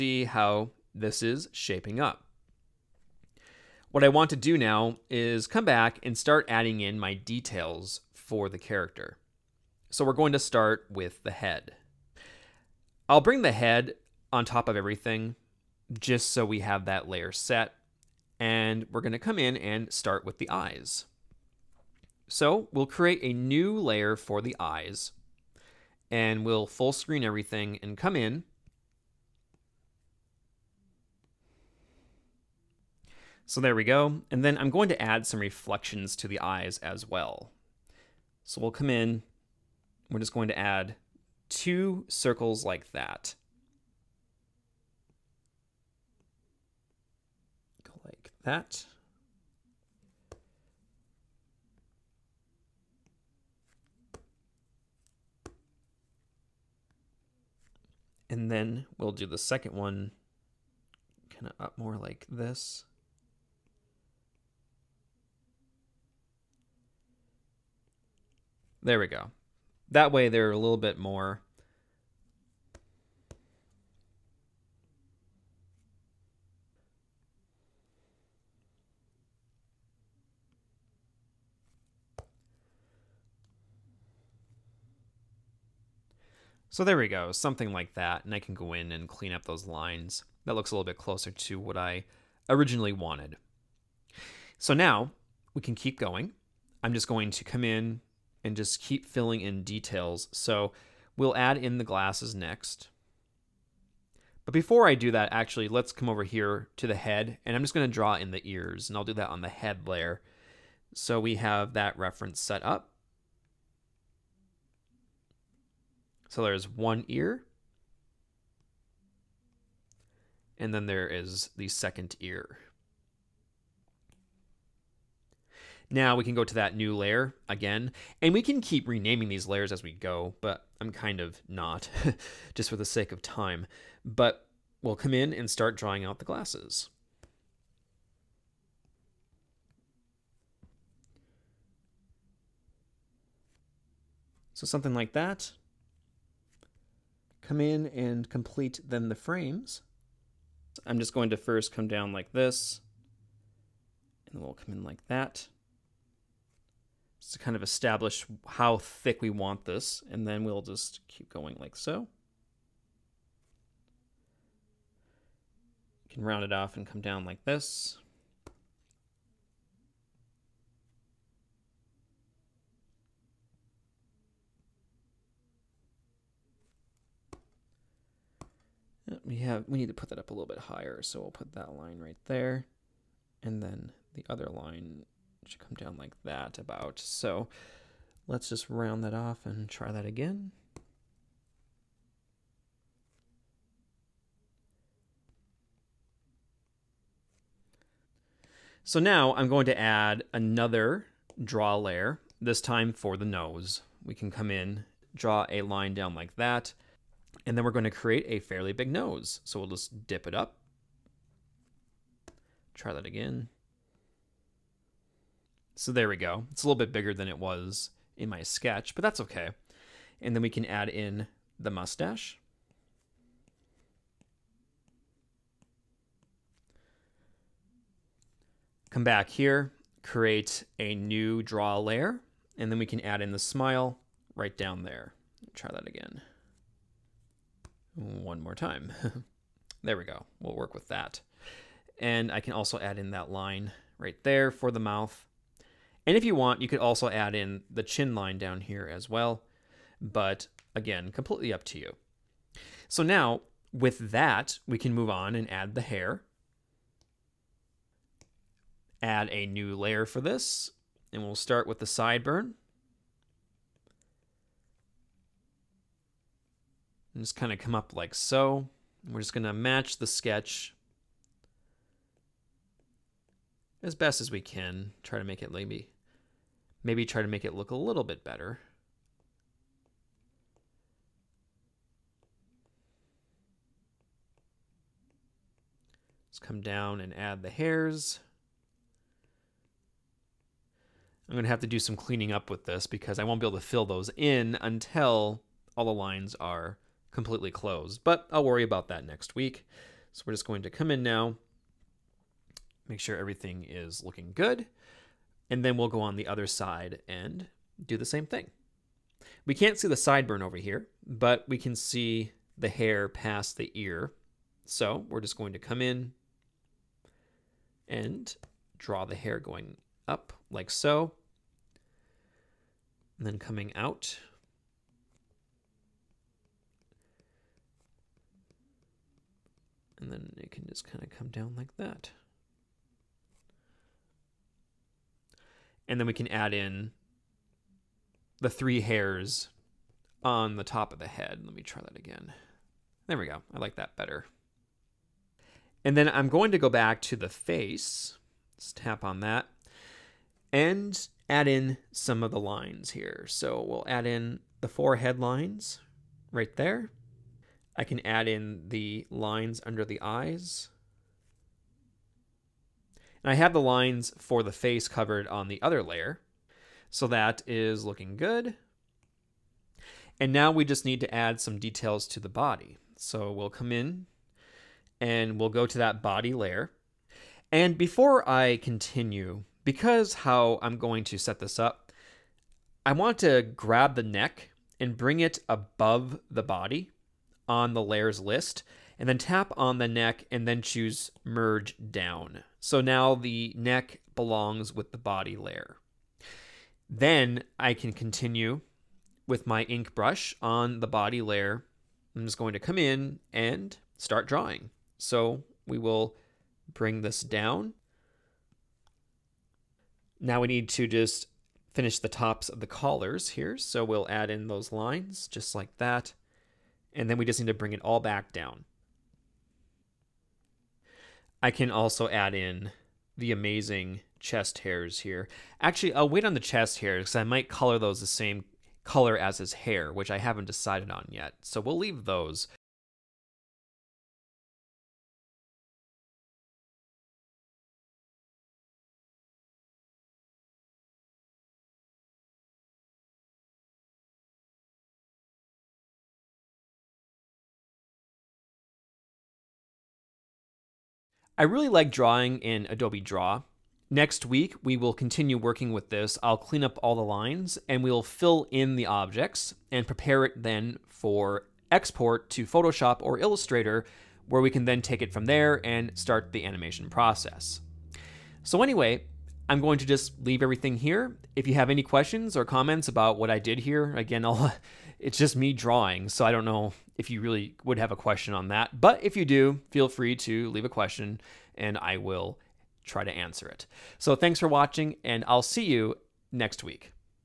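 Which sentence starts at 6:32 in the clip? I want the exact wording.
So now the neck belongs with the body layer.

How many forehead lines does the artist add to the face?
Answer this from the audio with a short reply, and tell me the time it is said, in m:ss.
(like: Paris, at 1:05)
4, at 5:54.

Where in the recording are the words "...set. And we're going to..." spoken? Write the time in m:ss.
0:17.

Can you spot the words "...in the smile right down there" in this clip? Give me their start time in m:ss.
3:53.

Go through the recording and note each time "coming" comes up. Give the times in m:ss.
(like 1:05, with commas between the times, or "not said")
5:23.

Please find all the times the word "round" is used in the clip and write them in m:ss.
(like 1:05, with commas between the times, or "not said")
2:46, 3:08.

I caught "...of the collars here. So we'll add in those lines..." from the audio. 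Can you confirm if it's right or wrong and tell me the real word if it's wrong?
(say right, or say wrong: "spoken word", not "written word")
right.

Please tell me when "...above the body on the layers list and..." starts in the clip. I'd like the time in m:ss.
6:25.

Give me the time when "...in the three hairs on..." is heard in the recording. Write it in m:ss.
5:36.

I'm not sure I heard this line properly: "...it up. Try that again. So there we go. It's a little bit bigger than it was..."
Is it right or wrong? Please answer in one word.
right.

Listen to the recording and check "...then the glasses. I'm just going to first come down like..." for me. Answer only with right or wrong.
wrong.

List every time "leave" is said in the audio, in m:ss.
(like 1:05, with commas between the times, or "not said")
7:11, 7:50, 8:00.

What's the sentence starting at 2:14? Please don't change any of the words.
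But we'll come in and start drawing out the glasses.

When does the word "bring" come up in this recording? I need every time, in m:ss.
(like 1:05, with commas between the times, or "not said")
0:13, 6:24, 6:46, 6:57.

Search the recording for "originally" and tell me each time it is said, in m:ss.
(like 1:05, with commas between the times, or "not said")
1:32.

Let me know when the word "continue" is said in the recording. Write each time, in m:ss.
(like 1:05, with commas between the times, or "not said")
6:18, 6:37, 7:34.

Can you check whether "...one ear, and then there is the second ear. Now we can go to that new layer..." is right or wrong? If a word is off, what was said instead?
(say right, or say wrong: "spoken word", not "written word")
right.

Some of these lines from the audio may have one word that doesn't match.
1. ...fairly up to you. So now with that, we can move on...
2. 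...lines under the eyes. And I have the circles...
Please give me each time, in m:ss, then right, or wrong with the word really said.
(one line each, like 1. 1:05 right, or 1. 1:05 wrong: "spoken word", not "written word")
1. 4:11 wrong: "completely", not "fairly"
2. 5:59 wrong: "lines", not "circles".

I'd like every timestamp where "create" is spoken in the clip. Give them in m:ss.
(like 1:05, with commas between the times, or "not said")
0:22, 3:27, 3:50.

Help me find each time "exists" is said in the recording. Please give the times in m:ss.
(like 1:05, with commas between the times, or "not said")
not said.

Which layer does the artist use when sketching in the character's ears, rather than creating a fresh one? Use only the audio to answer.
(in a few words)
head layer.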